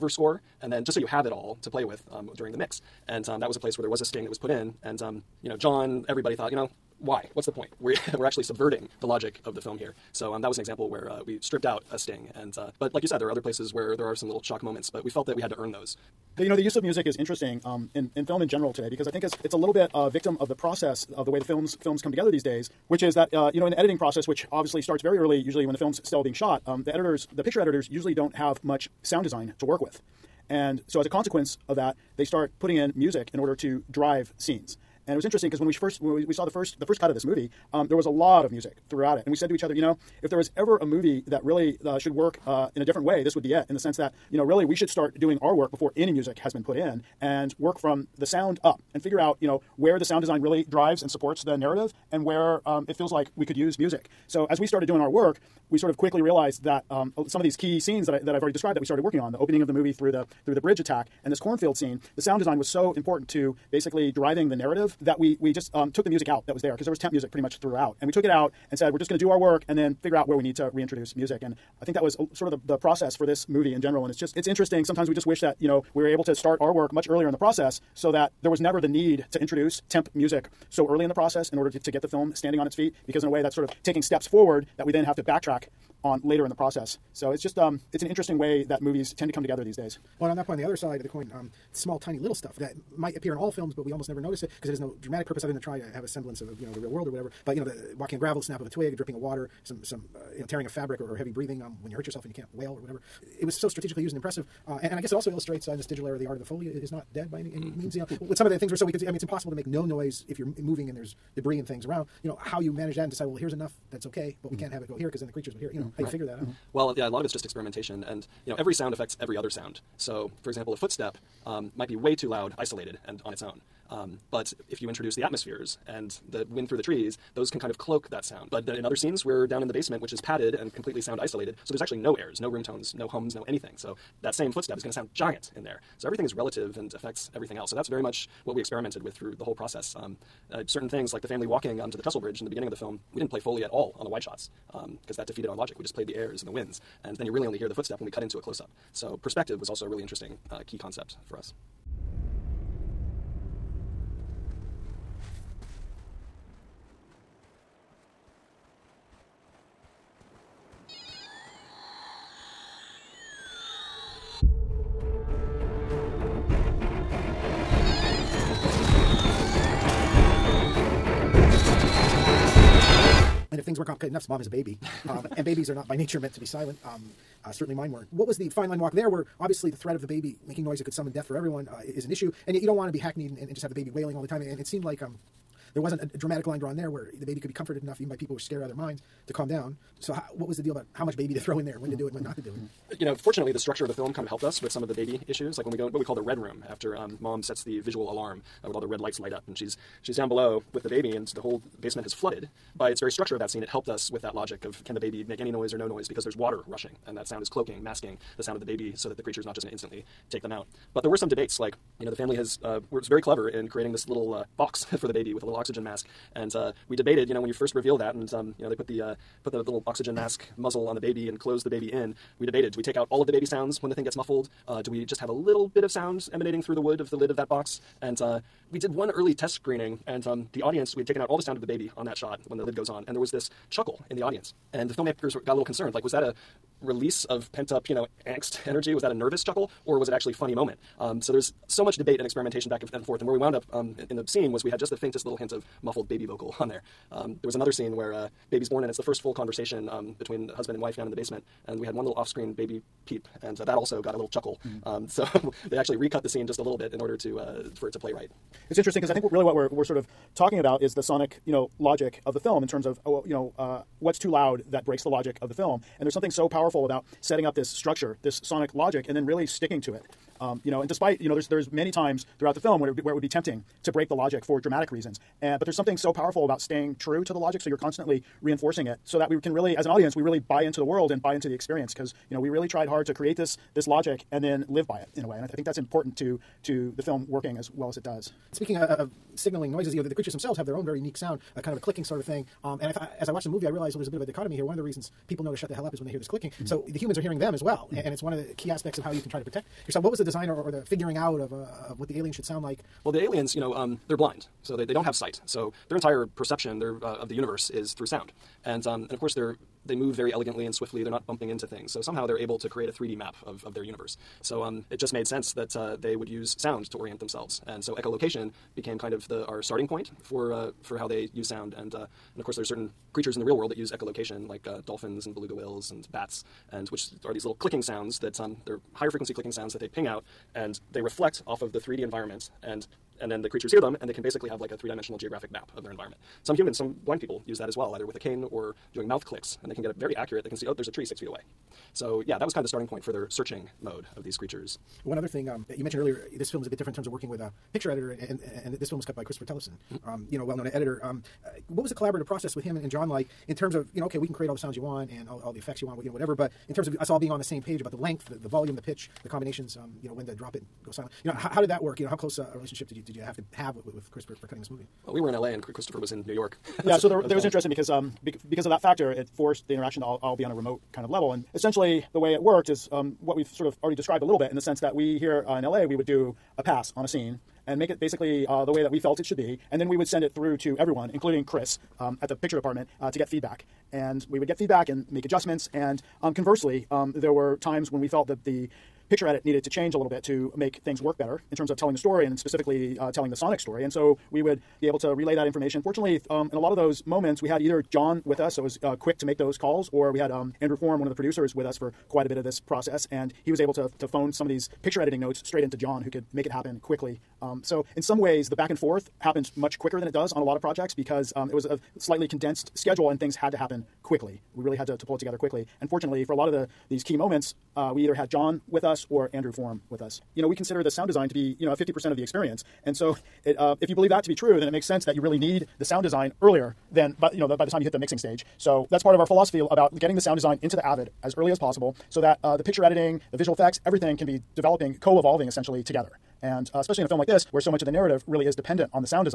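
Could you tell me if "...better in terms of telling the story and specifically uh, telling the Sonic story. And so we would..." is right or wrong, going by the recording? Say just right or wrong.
right.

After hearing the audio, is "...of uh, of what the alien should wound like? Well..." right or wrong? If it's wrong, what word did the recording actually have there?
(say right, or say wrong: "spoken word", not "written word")
wrong: "sound", not "wound".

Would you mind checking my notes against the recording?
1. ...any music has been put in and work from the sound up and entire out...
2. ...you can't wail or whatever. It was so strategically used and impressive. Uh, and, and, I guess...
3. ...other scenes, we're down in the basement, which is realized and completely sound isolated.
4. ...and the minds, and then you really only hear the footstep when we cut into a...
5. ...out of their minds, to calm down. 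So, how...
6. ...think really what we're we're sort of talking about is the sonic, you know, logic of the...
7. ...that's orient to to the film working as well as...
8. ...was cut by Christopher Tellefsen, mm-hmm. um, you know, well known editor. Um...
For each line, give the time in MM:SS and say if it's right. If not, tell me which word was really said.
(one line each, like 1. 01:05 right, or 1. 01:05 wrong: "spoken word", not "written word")
1. 00:45 wrong: "figure", not "entire"
2. 01:42 right
3. 02:08 wrong: "padded", not "realized"
4. 02:26 wrong: "winds", not "minds"
5. 03:08 right
6. 04:19 right
7. 04:45 wrong: "important", not "orient"
8. 05:48 right.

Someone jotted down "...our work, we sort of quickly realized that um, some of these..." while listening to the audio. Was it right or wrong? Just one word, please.
right.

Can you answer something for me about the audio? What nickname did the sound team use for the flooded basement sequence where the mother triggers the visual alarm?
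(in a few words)
The red room.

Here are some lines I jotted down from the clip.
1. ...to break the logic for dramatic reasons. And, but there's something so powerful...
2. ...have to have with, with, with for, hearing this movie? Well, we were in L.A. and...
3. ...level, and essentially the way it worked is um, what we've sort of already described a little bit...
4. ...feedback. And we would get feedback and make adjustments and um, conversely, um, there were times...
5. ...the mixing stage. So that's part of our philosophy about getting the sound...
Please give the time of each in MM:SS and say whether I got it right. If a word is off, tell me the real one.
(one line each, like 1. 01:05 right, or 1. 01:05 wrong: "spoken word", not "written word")
1. 04:33 right
2. 06:03 wrong: "cutting", not "hearing"
3. 06:11 right
4. 06:23 right
5. 07:07 right.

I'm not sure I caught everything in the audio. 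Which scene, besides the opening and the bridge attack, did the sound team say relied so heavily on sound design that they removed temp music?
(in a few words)
Cornfield scene.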